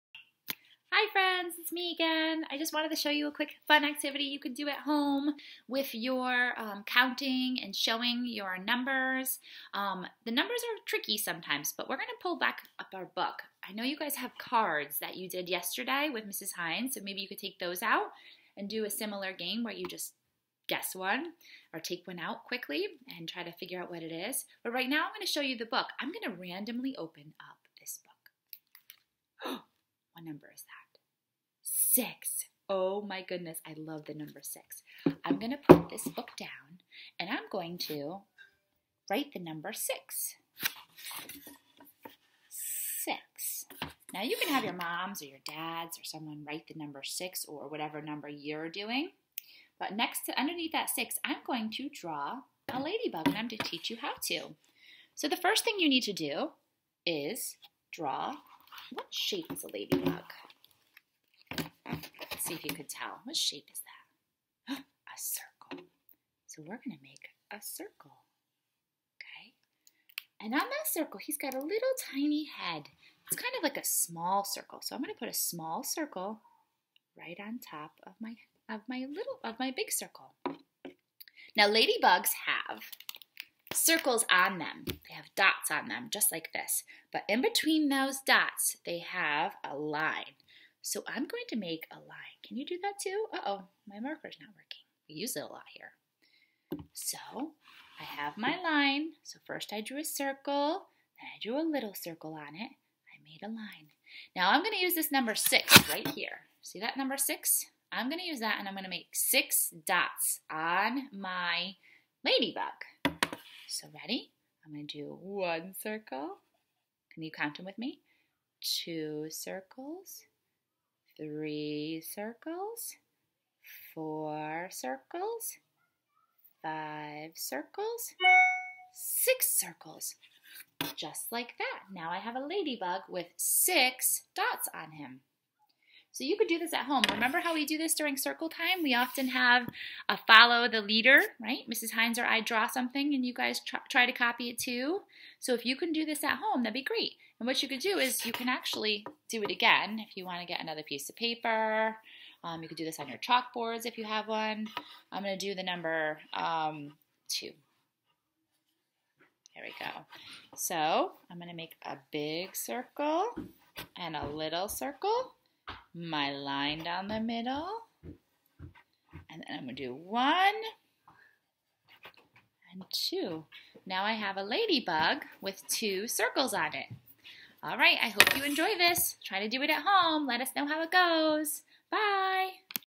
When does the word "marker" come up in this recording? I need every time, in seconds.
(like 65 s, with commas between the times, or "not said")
93 s.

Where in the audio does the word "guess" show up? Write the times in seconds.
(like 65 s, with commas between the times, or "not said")
20 s.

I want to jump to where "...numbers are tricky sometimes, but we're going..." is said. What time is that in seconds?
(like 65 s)
10 s.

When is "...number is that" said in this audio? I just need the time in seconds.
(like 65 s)
30 s.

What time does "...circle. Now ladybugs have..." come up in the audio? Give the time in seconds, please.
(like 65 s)
79 s.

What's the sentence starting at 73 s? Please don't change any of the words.
It's kind of like a small circle.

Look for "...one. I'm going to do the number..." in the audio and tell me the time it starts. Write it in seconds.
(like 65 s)
154 s.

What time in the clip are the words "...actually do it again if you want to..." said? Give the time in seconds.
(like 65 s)
148 s.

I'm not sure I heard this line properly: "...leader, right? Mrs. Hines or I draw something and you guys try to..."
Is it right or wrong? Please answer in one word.
right.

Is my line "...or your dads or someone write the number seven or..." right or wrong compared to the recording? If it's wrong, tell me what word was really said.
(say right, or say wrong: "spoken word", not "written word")
wrong: "six", not "seven".